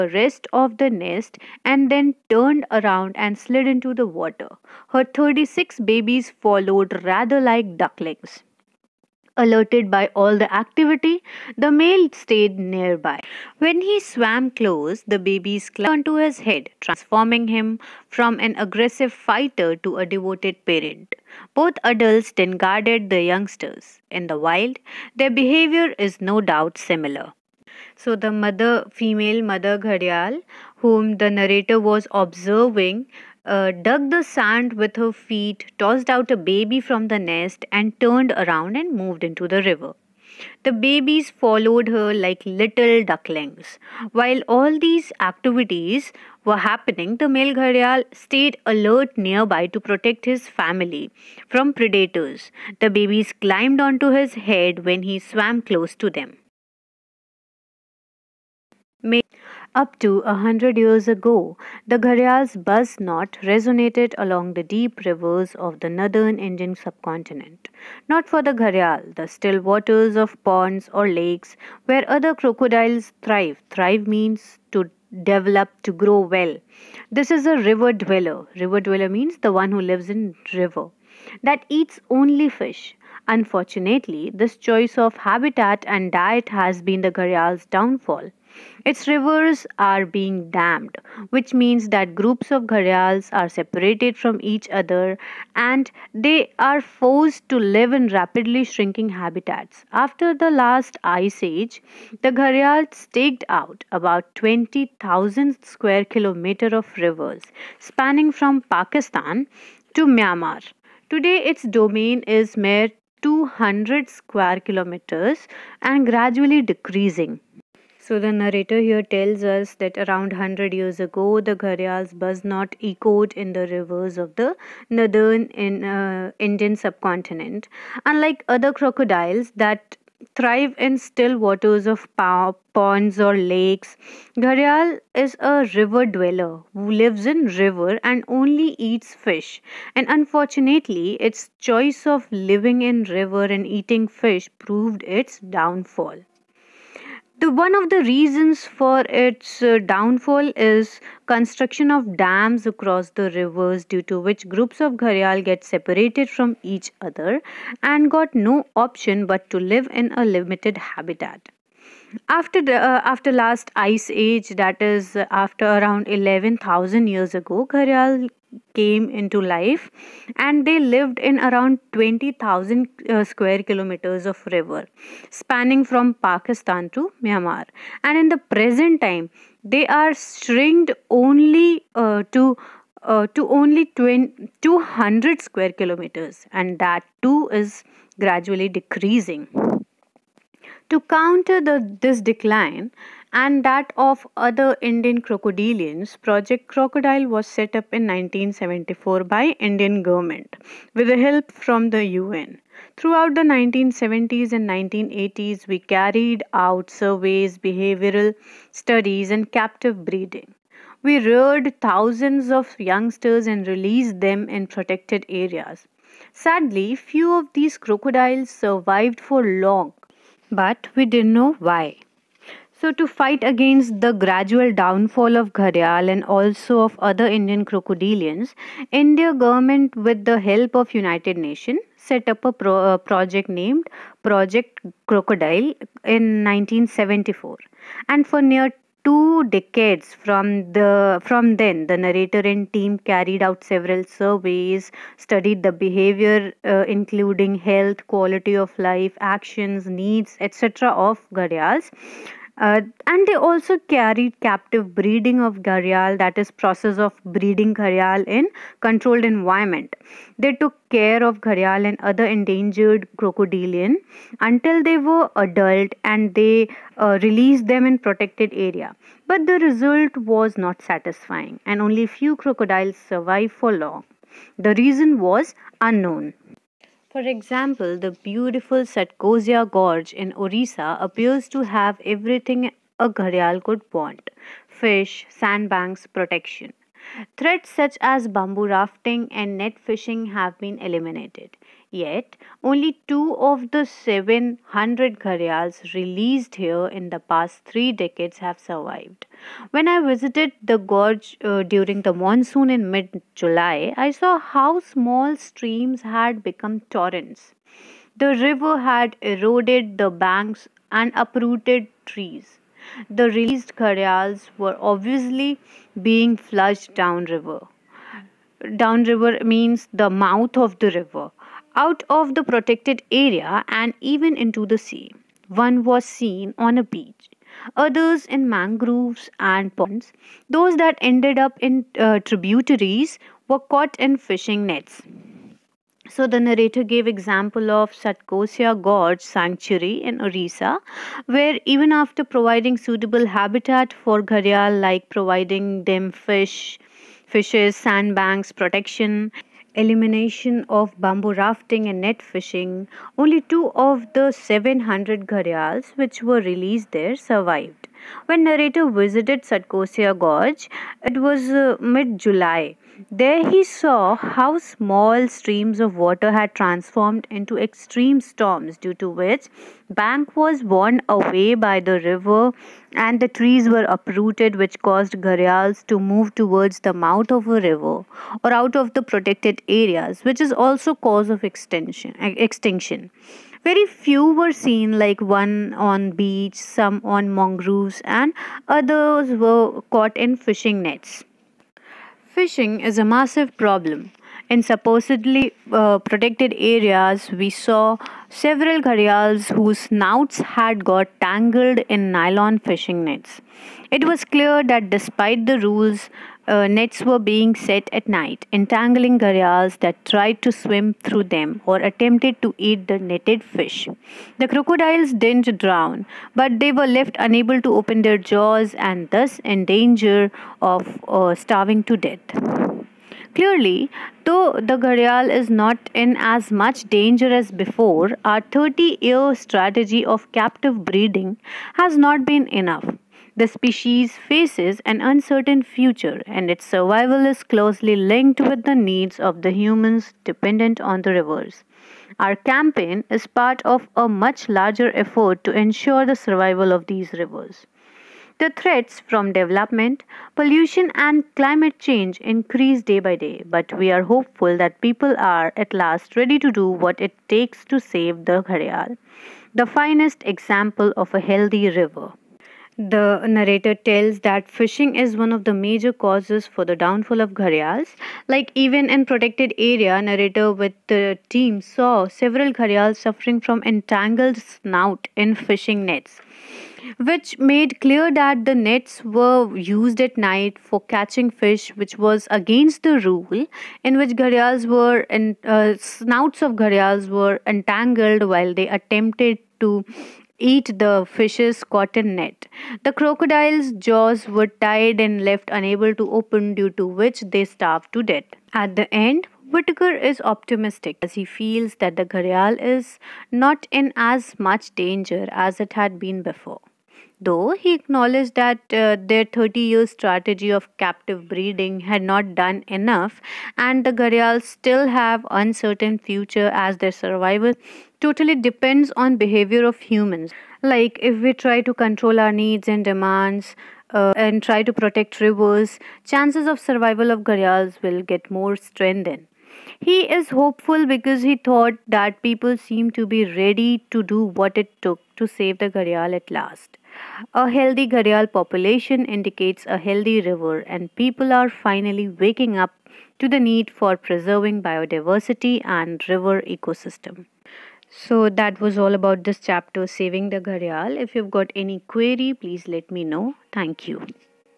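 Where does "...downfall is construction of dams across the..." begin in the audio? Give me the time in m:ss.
2:29.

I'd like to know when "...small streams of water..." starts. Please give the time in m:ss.
6:04.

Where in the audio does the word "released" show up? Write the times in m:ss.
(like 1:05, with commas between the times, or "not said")
3:33, 4:27, 4:55, 5:13, 5:56.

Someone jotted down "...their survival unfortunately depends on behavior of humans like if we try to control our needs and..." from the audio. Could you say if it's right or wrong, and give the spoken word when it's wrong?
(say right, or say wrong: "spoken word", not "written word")
wrong: "totally", not "unfortunately".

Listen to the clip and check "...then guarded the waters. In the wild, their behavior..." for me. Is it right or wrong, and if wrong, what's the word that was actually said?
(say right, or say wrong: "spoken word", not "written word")
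wrong: "youngsters", not "waters".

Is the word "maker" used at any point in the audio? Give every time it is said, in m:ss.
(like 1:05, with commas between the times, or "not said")
not said.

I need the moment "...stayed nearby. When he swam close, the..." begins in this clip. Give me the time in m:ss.
0:12.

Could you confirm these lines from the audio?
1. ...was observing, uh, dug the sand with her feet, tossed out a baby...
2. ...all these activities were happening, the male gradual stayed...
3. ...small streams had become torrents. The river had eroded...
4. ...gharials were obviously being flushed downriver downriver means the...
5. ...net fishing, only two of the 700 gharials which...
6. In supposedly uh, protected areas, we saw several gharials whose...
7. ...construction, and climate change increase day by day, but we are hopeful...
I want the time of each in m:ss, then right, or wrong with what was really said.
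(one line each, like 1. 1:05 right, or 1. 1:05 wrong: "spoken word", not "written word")
1. 0:31 right
2. 0:44 wrong: "gharial", not "gradual"
3. 5:04 right
4. 5:13 right
5. 5:52 right
6. 6:34 right
7. 7:30 wrong: "pollution", not "construction".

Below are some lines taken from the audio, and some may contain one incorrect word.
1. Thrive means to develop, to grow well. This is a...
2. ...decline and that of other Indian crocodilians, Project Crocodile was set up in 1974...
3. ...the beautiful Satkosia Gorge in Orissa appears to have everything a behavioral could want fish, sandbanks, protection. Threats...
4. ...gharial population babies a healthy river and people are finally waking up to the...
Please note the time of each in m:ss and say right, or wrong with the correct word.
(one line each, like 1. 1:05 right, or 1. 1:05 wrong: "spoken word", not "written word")
1. 1:13 right
2. 3:12 right
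3. 4:37 wrong: "gharial", not "behavioral"
4. 8:57 wrong: "indicates", not "babies".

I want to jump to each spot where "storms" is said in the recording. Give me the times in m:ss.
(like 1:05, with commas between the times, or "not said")
6:08.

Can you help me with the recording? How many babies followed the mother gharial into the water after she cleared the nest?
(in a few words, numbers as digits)
36.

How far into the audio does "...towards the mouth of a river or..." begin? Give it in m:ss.
6:16.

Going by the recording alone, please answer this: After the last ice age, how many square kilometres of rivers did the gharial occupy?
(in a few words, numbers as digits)
20,000 square kilometers.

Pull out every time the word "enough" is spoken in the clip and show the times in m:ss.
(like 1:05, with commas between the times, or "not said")
7:12, 8:32.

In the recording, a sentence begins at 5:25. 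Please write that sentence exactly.
One was seen on a beach, others in mangroves and ponds.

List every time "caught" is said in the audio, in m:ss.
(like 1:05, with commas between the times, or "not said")
5:33, 6:29.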